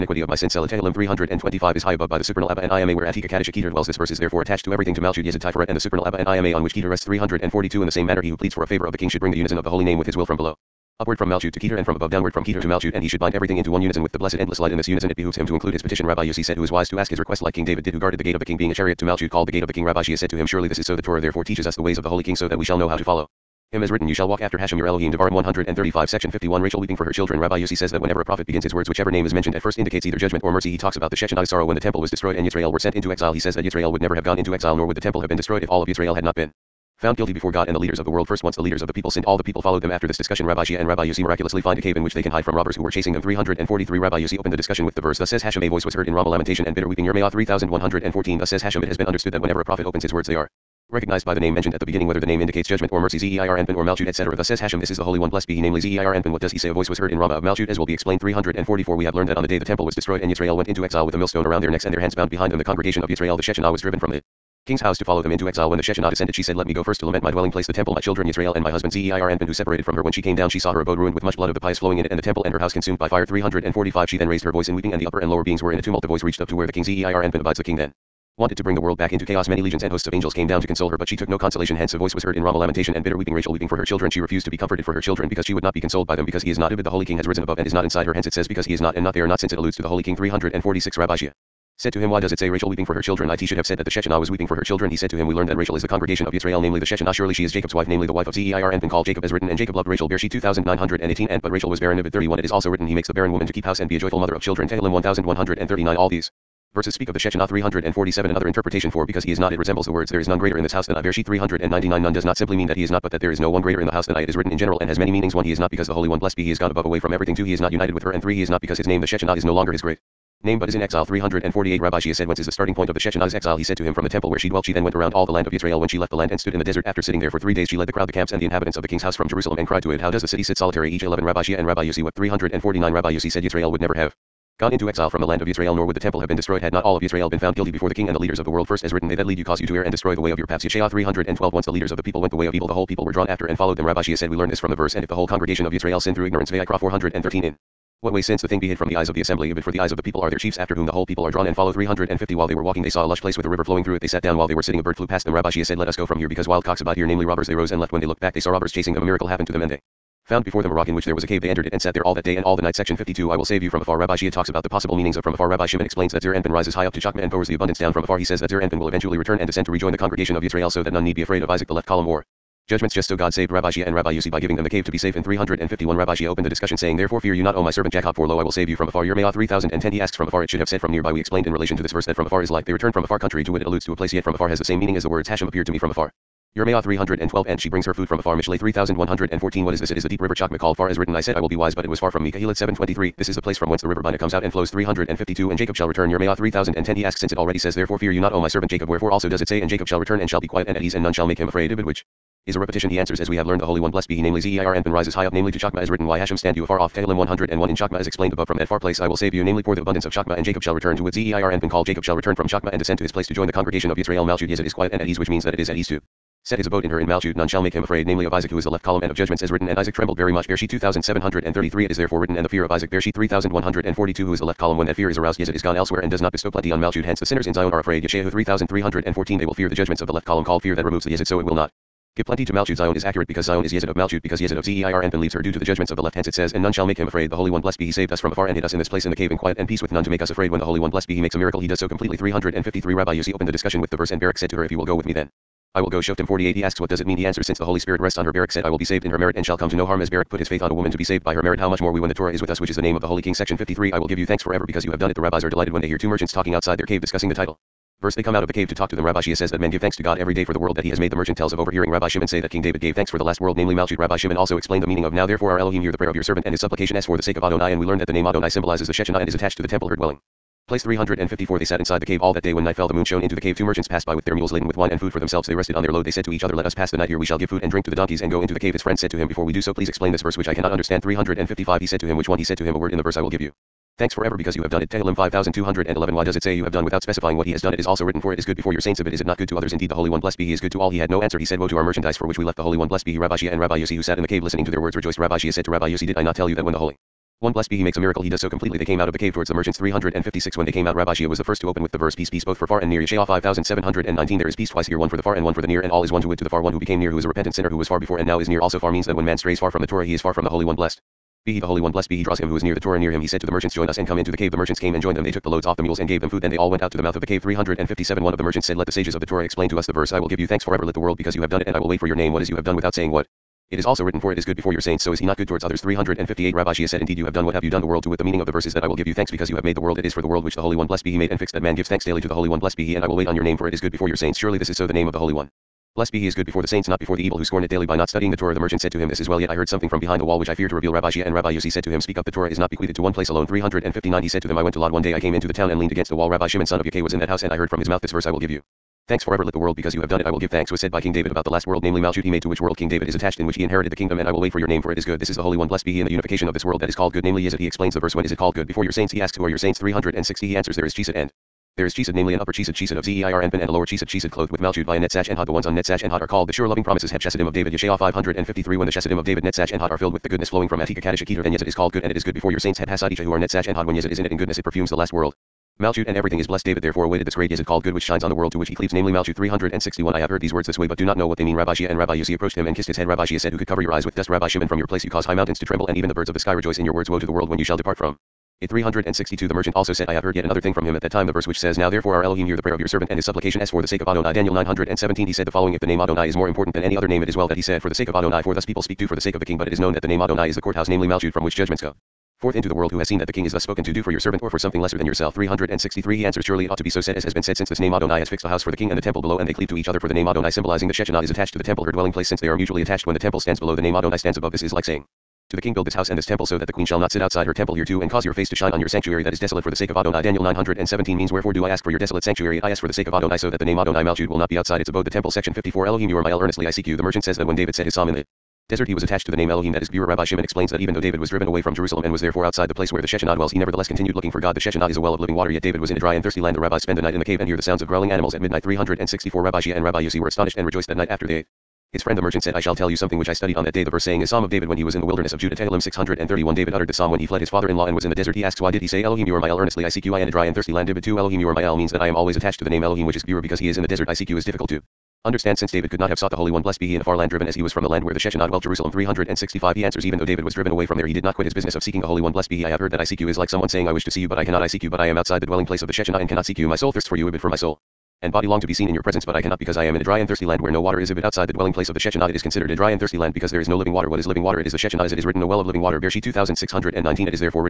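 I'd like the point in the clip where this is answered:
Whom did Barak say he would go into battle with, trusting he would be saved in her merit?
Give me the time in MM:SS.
04:09.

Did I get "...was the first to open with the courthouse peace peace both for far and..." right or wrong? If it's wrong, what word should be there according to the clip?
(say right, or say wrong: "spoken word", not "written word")
wrong: "verse", not "courthouse".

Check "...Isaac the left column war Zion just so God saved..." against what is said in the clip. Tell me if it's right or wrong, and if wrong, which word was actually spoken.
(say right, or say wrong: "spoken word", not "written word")
wrong: "Judgments", not "Zion".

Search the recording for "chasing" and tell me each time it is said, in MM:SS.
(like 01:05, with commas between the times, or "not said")
00:42, 02:38.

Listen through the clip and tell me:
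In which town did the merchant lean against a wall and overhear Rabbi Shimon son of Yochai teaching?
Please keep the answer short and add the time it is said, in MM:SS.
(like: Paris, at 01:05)
Lod, at 05:44.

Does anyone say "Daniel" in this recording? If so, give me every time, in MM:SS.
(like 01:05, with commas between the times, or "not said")
06:34, 07:00.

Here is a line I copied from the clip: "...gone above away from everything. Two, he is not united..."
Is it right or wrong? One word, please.
right.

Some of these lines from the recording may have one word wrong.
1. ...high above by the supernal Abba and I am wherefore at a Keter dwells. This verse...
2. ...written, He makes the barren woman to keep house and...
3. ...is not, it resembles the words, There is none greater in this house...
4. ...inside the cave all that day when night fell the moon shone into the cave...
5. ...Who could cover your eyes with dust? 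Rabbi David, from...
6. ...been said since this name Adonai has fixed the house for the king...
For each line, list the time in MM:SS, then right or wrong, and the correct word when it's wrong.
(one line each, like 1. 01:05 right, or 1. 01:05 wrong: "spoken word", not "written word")
1. 00:01 wrong: "aware", not "wherefore"
2. 01:42 right
3. 01:49 right
4. 04:31 right
5. 06:23 wrong: "Shimon", not "David"
6. 06:47 right.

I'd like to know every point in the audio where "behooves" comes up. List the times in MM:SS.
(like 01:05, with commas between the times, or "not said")
00:15.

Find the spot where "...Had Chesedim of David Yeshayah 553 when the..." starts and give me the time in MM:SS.
06:07.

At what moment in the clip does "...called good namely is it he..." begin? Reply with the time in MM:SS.
05:56.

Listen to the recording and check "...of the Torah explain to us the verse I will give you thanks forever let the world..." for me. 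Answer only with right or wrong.
right.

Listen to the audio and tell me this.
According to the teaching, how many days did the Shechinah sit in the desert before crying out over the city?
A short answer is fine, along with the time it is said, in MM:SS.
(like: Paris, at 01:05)
3, at 02:06.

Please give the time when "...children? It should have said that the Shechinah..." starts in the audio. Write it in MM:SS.
01:33.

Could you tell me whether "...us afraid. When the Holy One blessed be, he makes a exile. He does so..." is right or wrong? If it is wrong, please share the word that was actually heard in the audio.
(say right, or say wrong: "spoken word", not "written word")
wrong: "miracle", not "exile".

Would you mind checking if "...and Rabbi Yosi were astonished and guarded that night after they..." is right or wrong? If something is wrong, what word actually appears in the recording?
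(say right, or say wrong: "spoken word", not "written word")
wrong: "rejoiced", not "guarded".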